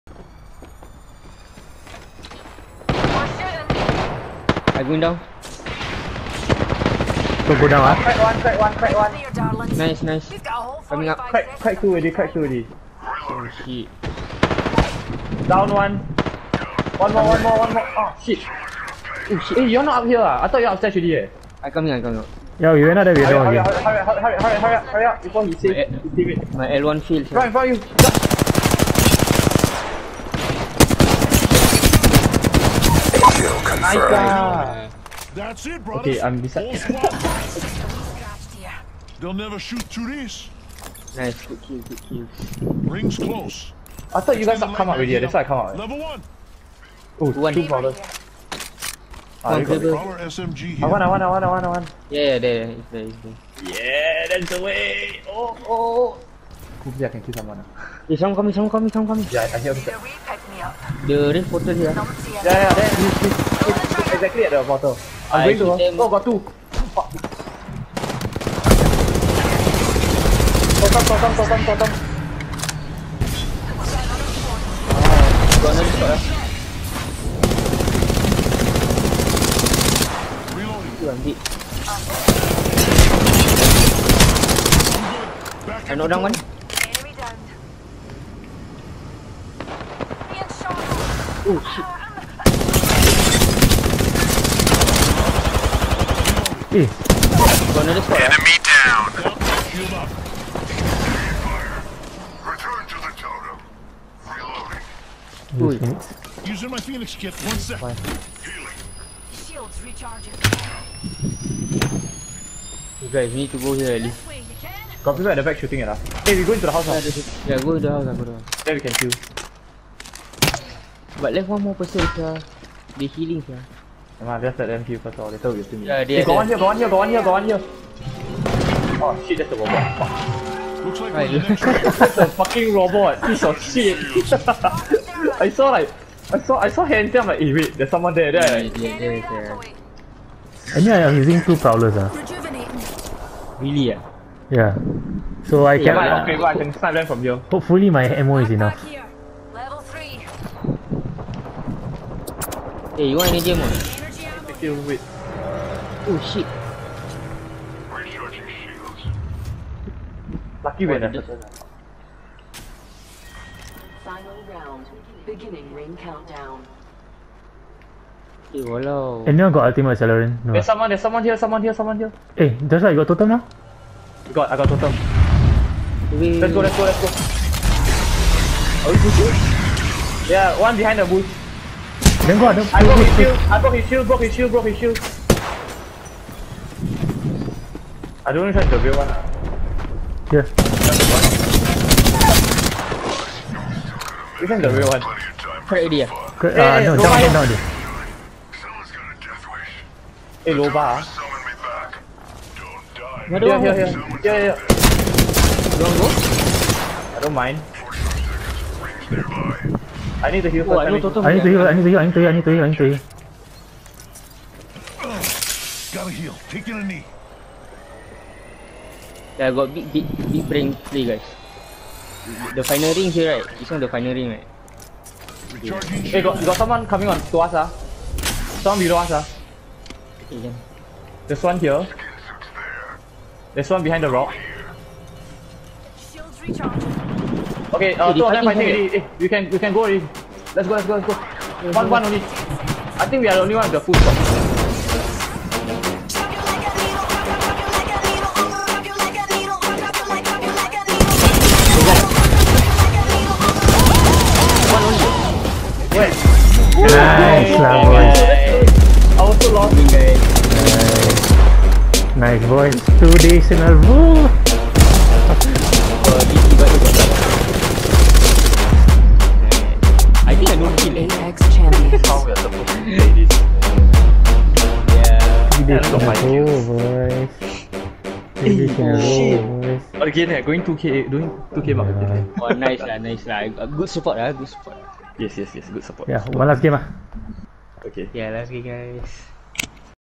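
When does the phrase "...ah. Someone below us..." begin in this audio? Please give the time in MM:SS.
03:47.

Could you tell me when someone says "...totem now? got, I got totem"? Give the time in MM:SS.
02:53.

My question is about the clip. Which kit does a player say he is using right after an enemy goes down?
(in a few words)
Phoenix kit.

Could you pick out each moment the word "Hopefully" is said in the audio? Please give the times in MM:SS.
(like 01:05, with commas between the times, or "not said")
00:56, 02:27.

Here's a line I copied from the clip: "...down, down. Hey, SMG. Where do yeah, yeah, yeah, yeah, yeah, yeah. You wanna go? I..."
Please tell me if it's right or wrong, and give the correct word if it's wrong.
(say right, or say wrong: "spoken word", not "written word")
wrong: "Loba", not "SMG".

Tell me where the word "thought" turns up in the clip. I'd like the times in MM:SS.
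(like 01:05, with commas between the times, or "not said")
00:20, 00:44.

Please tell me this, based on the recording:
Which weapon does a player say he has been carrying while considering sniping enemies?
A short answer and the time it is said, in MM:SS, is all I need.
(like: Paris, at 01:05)
Prowlers, at 02:21.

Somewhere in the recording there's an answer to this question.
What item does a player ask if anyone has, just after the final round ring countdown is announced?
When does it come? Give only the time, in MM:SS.
02:49.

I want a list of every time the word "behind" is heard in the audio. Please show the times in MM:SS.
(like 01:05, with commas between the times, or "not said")
03:00, 03:53.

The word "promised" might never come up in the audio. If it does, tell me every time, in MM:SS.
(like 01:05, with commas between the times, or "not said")
not said.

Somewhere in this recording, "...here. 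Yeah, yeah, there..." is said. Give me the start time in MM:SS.
01:01.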